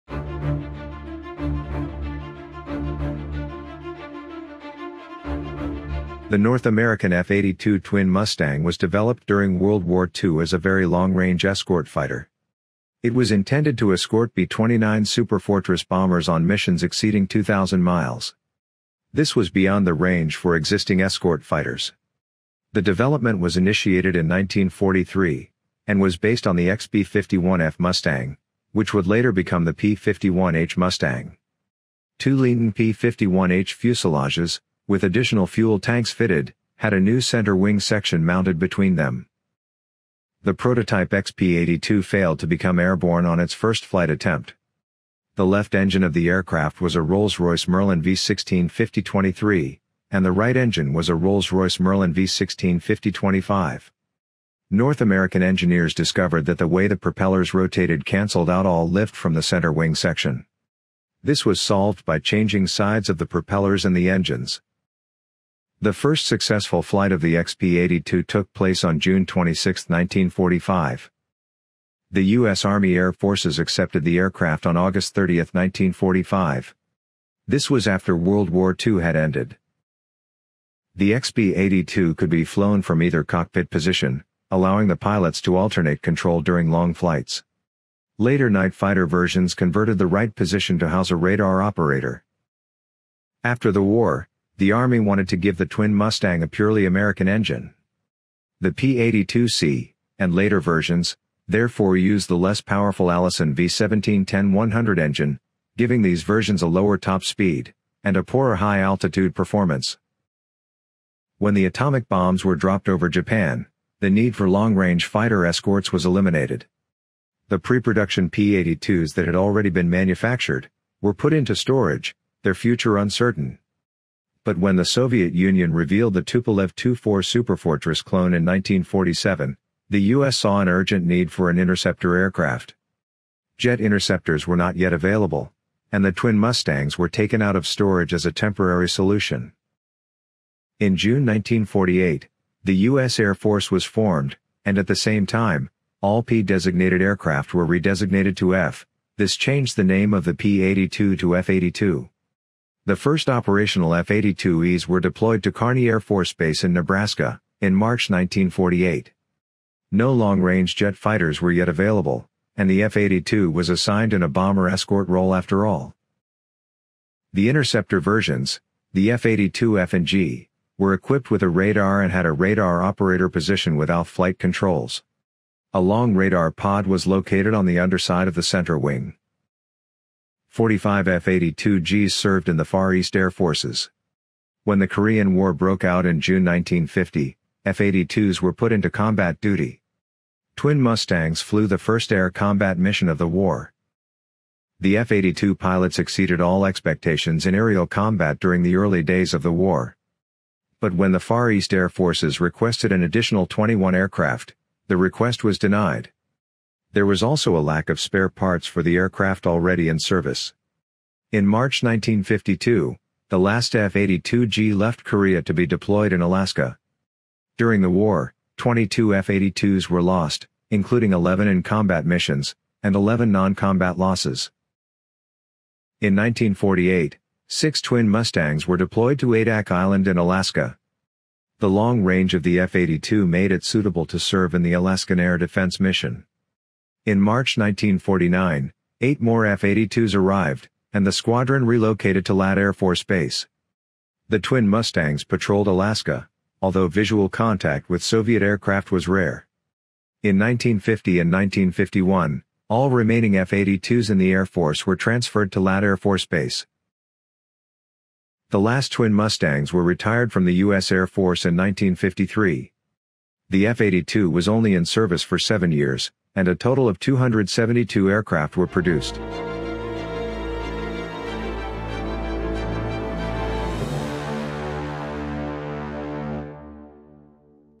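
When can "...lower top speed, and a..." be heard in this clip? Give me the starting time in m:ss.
1:46.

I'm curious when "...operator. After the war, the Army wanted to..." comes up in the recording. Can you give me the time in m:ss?
1:31.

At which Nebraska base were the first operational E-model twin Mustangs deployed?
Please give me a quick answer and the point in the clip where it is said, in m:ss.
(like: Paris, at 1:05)
Kearney Air Force Base, at 2:35.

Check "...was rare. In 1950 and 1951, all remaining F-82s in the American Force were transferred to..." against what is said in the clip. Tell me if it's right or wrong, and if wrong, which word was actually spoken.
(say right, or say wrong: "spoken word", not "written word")
wrong: "Air", not "American".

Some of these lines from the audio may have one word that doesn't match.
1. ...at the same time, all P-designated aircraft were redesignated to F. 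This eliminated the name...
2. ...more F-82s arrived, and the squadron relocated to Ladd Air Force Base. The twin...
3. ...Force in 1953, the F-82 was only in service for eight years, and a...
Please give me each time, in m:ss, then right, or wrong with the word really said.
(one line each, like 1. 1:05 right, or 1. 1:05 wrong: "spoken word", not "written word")
1. 2:24 wrong: "changed", not "eliminated"
2. 3:59 right
3. 4:21 wrong: "seven", not "eight".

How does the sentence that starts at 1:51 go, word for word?
When the atomic bombs were dropped over Japan, the need for long-range fighter escorts was eliminated.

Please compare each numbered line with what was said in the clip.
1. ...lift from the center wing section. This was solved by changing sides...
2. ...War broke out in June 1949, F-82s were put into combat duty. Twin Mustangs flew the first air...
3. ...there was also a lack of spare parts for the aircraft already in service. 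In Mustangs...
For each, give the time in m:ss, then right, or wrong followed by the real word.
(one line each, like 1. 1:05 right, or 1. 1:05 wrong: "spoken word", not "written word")
1. 0:58 right
2. 3:05 wrong: "1950", not "1949"
3. 3:26 wrong: "March", not "Mustangs".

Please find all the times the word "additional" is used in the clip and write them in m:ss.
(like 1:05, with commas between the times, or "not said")
0:35, 3:23.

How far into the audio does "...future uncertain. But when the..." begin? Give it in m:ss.
2:02.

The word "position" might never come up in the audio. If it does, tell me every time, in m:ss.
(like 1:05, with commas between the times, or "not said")
1:23, 1:30, 2:53.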